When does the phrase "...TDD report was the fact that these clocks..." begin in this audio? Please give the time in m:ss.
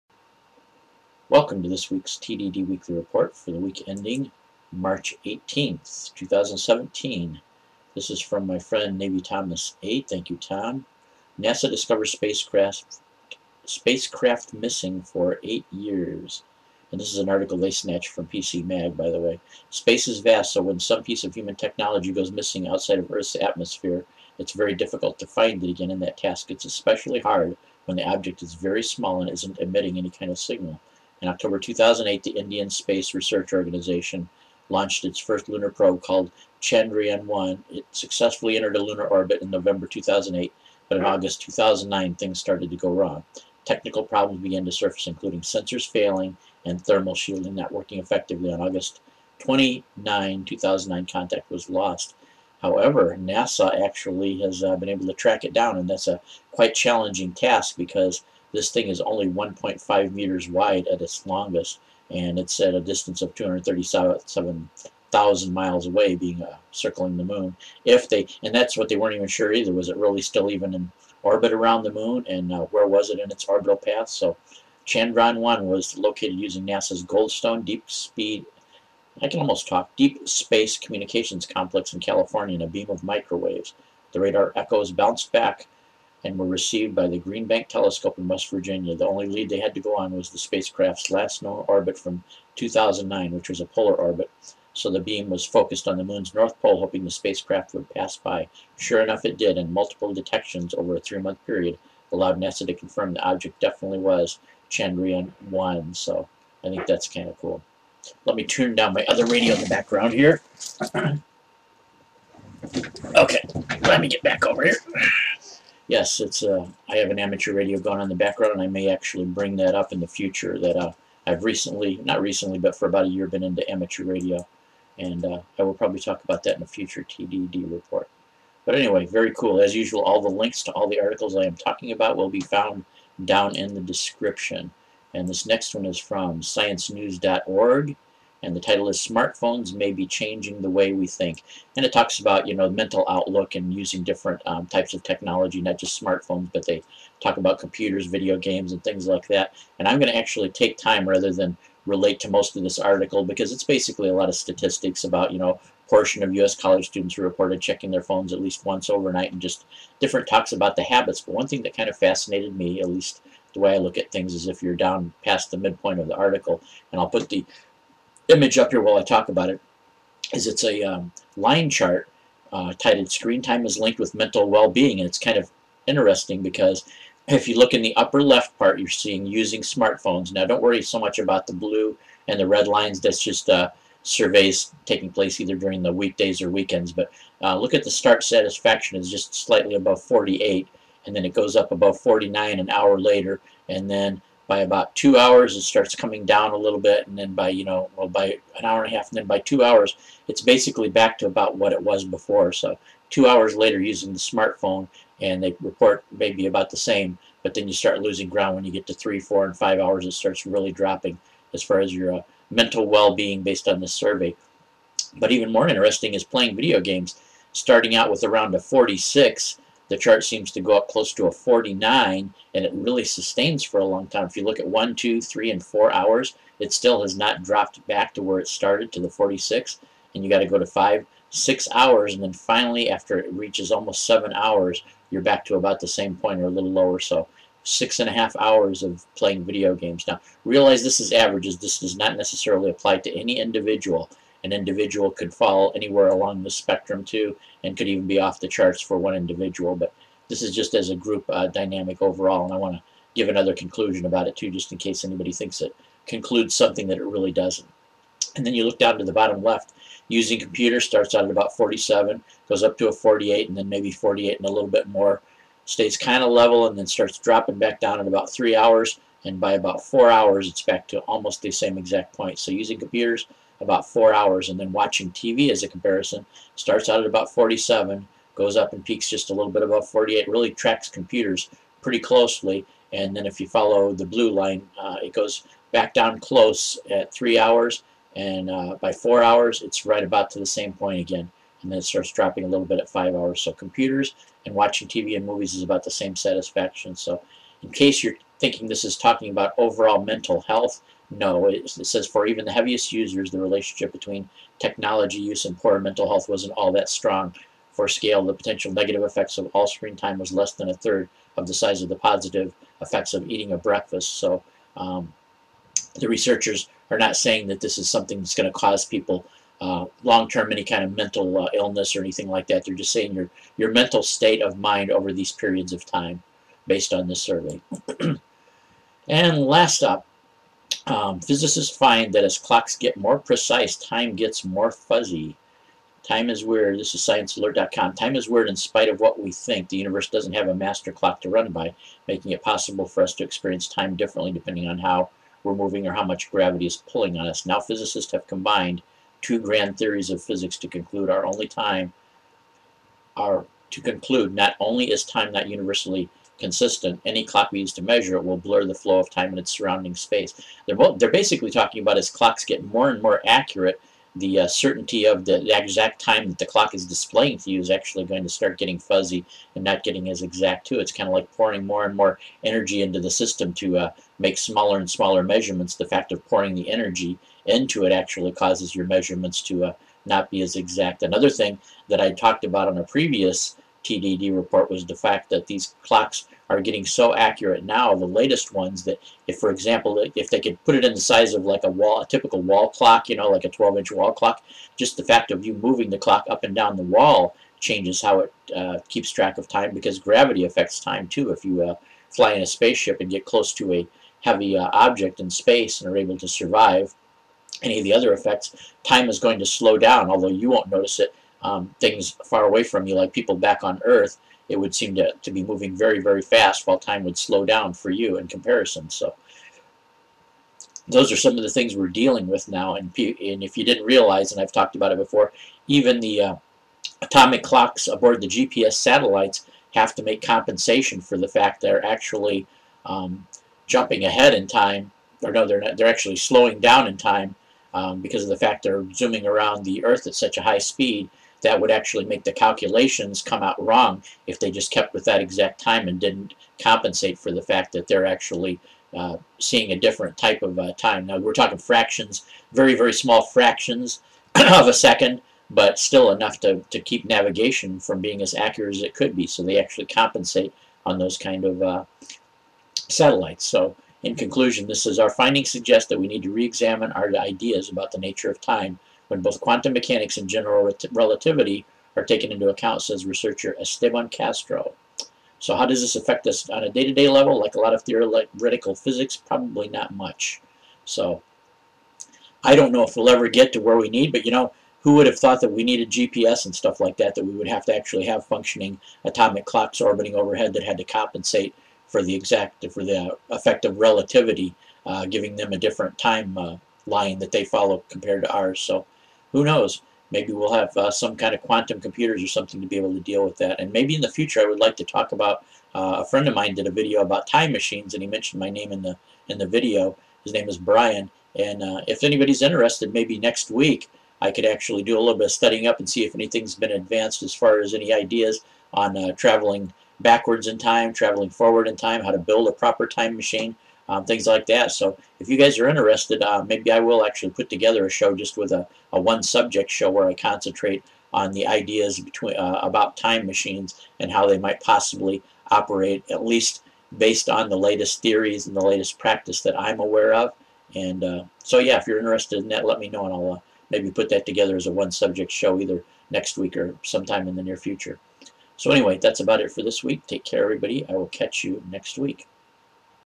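6:23.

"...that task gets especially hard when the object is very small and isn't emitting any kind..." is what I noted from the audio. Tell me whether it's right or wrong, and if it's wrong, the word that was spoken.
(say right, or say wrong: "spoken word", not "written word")
right.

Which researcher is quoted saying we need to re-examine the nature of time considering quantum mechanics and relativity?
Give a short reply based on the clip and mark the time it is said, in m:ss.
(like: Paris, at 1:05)
Esteban Castro, at 7:53.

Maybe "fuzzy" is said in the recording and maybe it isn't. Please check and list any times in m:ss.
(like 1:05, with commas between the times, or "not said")
5:34, 6:08.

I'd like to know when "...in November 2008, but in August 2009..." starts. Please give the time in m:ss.
0:39.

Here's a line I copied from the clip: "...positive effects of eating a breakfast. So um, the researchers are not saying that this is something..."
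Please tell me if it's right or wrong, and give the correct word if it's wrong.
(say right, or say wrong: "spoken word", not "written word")
right.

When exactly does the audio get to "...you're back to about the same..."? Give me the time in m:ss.
3:55.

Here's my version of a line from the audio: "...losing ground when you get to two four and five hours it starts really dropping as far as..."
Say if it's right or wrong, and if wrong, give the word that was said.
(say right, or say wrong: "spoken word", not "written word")
wrong: "three", not "two".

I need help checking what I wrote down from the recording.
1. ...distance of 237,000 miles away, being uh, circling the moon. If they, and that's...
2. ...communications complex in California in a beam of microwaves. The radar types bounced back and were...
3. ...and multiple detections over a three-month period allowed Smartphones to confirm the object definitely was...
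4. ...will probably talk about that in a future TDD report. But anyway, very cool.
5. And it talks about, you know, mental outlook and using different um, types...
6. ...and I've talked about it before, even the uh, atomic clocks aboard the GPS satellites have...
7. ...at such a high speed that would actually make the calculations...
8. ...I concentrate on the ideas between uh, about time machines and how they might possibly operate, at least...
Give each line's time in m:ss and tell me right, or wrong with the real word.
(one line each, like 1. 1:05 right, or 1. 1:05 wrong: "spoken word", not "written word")
1. 1:02 right
2. 1:20 wrong: "echoes", not "types"
3. 1:39 wrong: "NASA", not "Smartphones"
4. 2:05 right
5. 2:21 right
6. 7:04 right
7. 7:20 right
8. 8:50 right.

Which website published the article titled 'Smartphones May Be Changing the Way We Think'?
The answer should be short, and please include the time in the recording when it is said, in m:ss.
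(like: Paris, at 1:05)
sciencenews.org, at 2:16.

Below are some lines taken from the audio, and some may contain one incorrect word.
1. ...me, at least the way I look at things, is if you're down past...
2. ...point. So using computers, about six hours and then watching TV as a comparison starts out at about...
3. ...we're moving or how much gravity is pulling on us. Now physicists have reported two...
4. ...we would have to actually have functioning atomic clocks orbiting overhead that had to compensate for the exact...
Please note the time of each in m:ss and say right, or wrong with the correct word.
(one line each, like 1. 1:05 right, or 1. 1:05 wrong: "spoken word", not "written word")
1. 2:42 right
2. 4:32 wrong: "four", not "six"
3. 5:45 wrong: "combined", not "reported"
4. 8:07 right.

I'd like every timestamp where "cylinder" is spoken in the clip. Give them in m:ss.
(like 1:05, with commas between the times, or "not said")
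not said.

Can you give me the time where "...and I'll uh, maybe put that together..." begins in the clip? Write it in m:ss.
9:03.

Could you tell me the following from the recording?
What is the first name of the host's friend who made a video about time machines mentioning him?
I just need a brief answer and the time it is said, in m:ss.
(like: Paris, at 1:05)
Brian, at 8:30.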